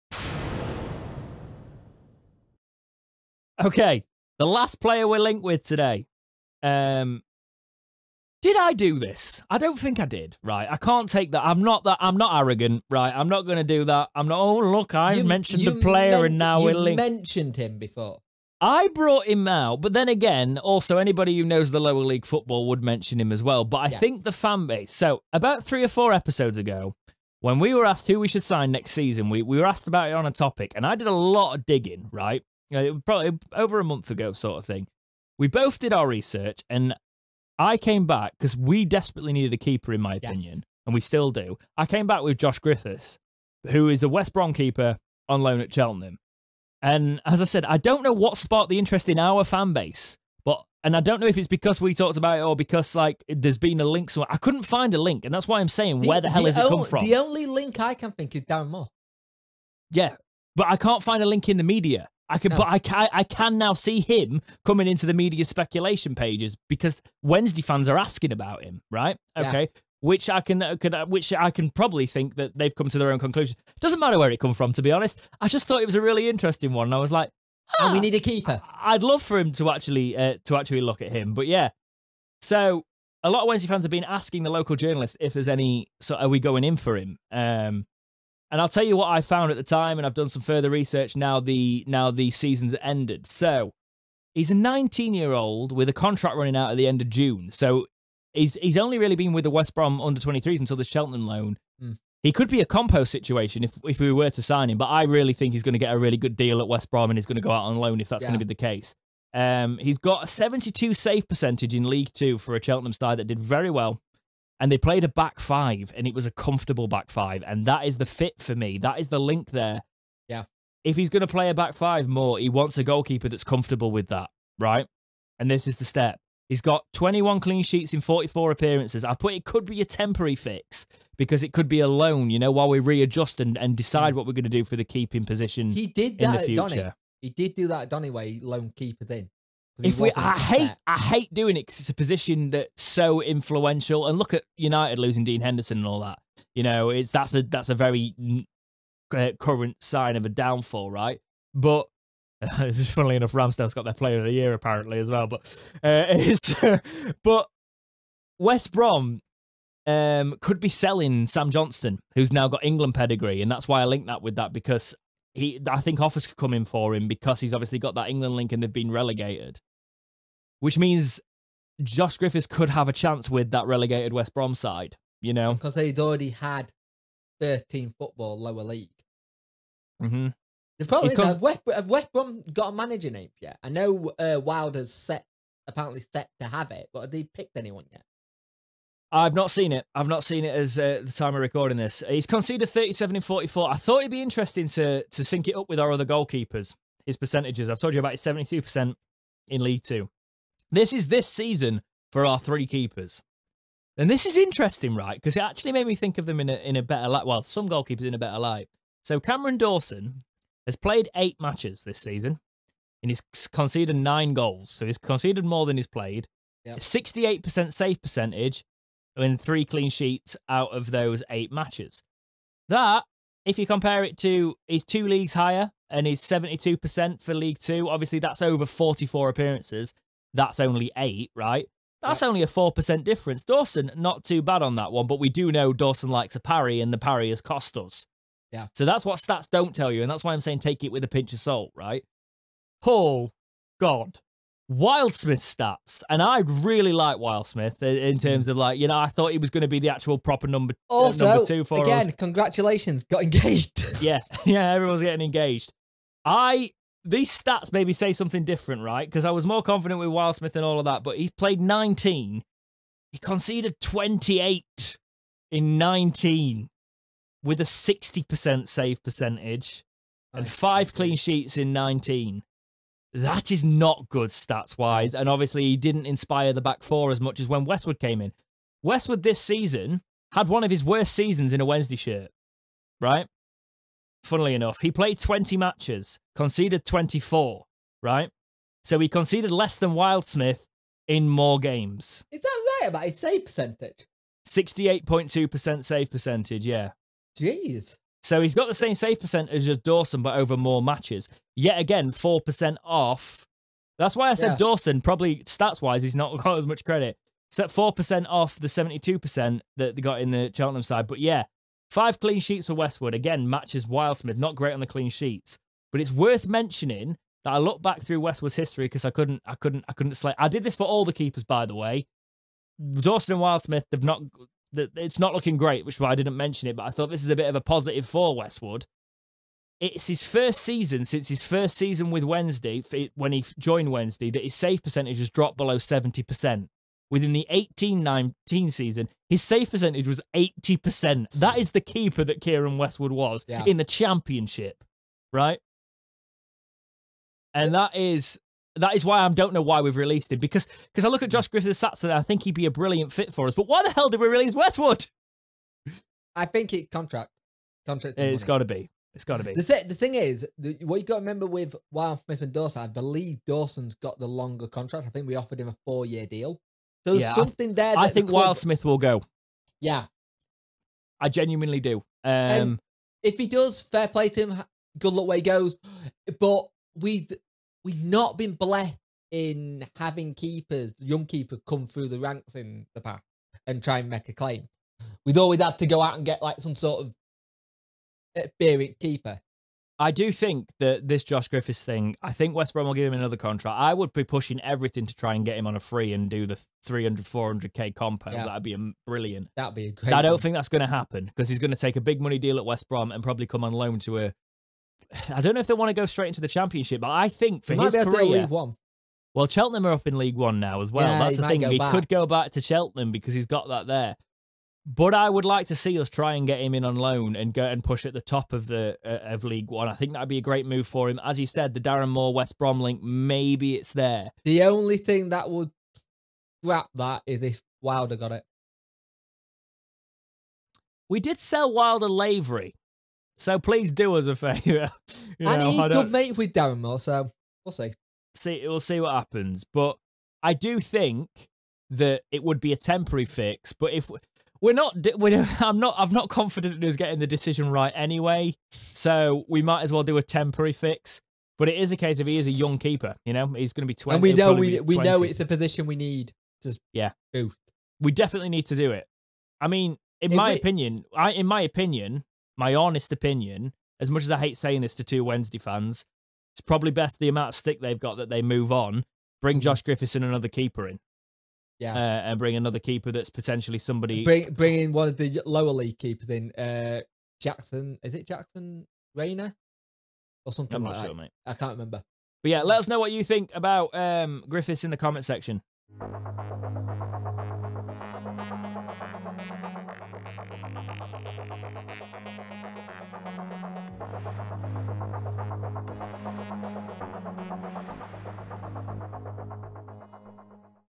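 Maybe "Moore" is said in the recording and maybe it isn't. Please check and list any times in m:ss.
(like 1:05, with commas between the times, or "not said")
0:58, 7:02, 7:16.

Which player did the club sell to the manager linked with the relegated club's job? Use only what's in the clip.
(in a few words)
Lavery.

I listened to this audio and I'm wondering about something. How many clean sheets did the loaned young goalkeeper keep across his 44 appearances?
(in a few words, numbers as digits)
21.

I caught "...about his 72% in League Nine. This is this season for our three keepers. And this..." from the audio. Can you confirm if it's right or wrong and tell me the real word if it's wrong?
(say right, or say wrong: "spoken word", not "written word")
wrong: "Two", not "Nine".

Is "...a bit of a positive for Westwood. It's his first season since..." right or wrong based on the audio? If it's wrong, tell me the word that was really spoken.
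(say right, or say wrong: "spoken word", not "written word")
right.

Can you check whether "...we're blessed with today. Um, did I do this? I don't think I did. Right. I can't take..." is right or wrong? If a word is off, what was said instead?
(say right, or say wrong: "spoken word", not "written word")
wrong: "linked", not "blessed".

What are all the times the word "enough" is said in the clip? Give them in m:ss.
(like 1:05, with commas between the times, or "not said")
2:33, 4:44.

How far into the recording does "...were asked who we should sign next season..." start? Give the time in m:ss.
0:27.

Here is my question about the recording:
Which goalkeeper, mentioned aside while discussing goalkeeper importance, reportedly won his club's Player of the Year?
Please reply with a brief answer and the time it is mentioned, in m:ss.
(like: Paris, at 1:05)
Ramsdale, at 2:33.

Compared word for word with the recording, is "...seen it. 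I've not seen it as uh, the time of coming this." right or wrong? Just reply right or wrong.
wrong.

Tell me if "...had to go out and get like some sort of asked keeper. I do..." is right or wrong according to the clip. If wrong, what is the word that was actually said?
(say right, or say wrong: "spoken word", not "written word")
wrong: "experienced", not "asked".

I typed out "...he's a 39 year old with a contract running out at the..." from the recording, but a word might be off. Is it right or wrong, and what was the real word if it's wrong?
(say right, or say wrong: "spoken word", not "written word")
wrong: "19", not "39".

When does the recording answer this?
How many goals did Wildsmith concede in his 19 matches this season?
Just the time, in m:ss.
4:23.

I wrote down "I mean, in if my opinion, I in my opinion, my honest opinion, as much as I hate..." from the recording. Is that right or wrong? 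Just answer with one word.
right.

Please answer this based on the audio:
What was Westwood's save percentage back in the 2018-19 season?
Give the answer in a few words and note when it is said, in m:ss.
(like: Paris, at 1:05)
80%, at 5:40.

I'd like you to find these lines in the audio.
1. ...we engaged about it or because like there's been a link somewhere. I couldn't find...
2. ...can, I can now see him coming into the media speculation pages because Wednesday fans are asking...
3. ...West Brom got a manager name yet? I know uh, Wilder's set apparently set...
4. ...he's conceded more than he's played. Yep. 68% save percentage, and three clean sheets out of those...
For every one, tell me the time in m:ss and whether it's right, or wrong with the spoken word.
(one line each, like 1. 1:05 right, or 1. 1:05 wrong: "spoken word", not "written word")
1. 0:51 wrong: "talked", not "engaged"
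2. 1:02 right
3. 3:01 right
4. 3:34 right.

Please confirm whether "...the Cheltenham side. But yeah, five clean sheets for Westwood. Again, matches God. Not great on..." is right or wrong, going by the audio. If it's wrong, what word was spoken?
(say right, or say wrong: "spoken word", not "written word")
wrong: "Wildsmith", not "God".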